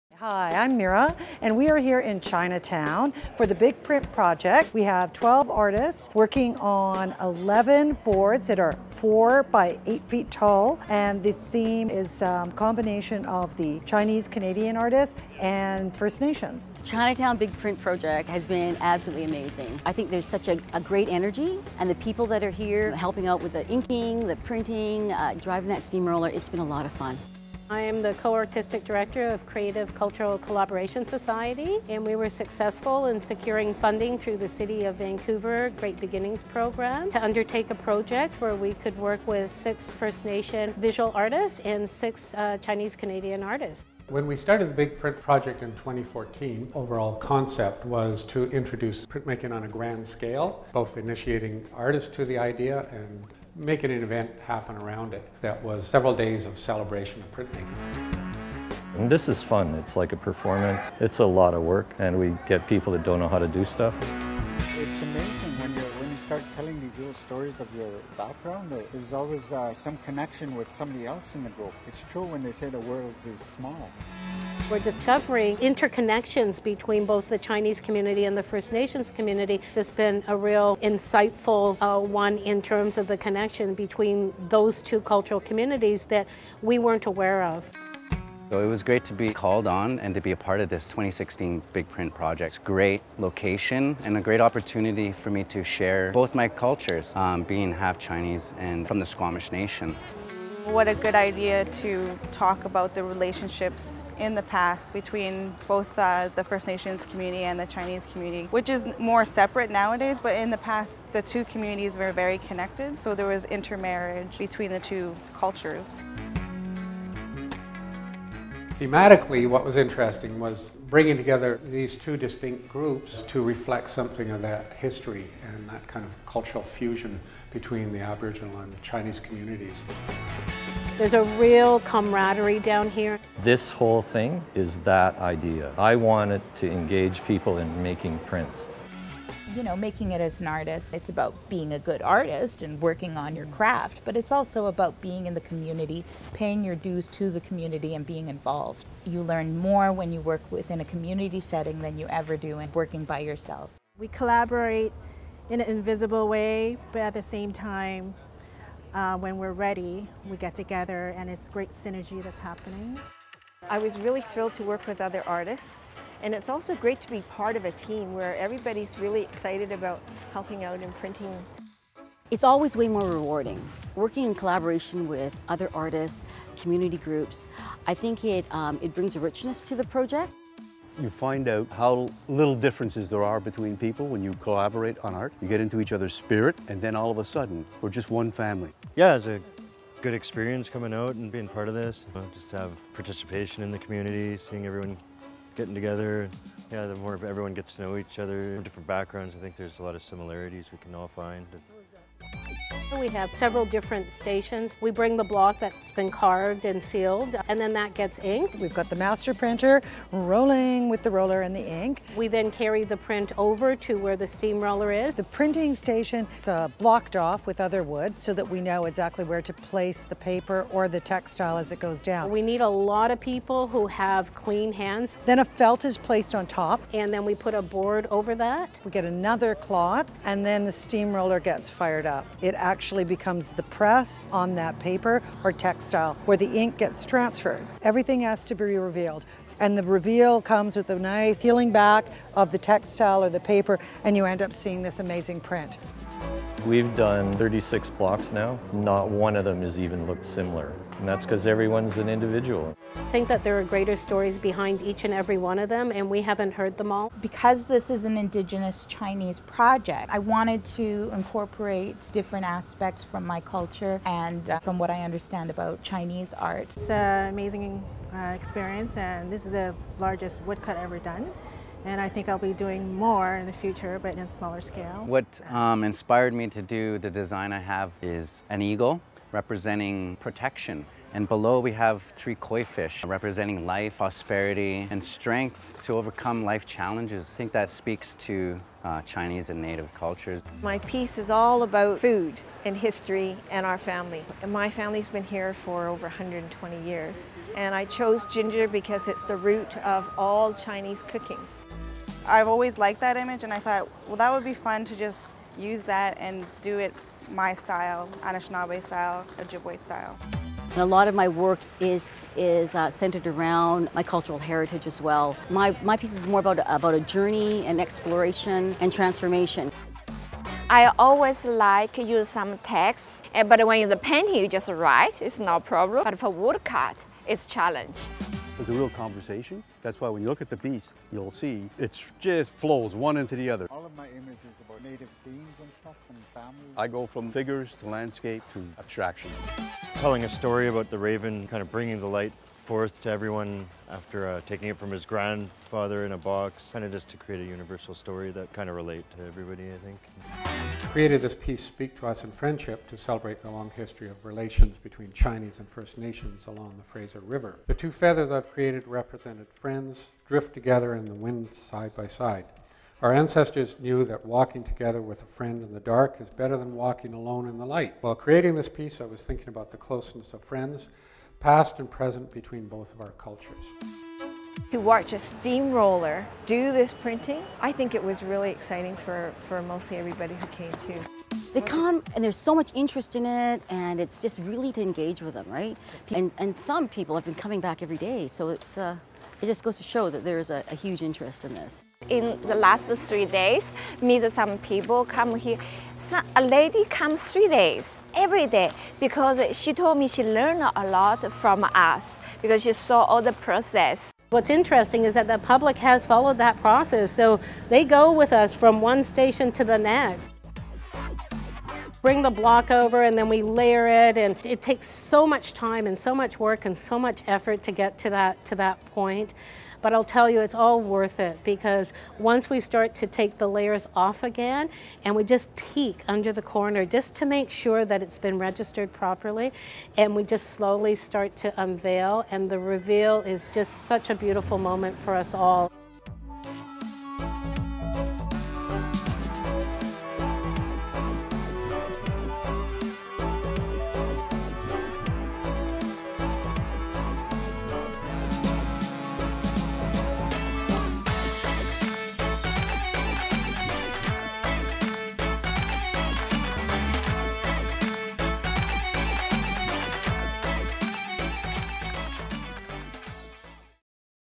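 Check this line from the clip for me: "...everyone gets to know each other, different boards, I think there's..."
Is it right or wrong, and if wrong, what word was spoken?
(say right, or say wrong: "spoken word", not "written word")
wrong: "backgrounds", not "boards".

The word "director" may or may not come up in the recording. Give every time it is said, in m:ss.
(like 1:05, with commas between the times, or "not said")
0:28.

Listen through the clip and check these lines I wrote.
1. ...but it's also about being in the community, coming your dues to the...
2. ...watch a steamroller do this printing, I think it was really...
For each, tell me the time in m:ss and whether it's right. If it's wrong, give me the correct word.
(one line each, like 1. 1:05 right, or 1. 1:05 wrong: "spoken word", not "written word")
1. 2:24 wrong: "paying", not "coming"
2. 6:14 right.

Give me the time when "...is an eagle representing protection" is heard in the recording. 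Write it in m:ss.
4:38.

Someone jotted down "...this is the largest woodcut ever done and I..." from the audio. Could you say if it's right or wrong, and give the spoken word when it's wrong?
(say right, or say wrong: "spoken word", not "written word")
right.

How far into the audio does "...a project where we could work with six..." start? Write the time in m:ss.
0:37.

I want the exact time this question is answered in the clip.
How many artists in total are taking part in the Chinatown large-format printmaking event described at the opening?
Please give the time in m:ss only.
0:05.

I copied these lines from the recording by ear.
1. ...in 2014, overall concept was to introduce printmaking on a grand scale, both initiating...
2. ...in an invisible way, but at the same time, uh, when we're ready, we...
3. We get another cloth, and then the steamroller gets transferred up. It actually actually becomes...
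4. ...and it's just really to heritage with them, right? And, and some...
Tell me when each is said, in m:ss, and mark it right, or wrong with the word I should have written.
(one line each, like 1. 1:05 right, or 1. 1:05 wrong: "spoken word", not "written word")
1. 0:45 right
2. 2:35 right
3. 3:48 wrong: "fired", not "transferred"
4. 6:23 wrong: "engage", not "heritage".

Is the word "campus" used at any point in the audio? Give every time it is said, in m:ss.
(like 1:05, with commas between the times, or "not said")
not said.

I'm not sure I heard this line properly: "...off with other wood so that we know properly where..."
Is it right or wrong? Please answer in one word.
wrong.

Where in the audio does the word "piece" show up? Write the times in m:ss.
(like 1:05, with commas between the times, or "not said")
4:50, 5:15, 5:51, 6:08.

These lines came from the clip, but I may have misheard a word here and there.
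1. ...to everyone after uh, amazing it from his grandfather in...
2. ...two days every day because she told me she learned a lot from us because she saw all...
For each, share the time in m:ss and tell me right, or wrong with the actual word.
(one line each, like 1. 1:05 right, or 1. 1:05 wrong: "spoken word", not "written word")
1. 5:43 wrong: "taking", not "amazing"
2. 6:37 wrong: "three", not "two".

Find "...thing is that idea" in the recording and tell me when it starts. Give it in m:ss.
2:14.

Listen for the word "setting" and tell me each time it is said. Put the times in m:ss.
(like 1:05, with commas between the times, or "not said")
2:31.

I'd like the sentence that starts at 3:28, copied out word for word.
We've got the master printer rolling with the roller and the ink.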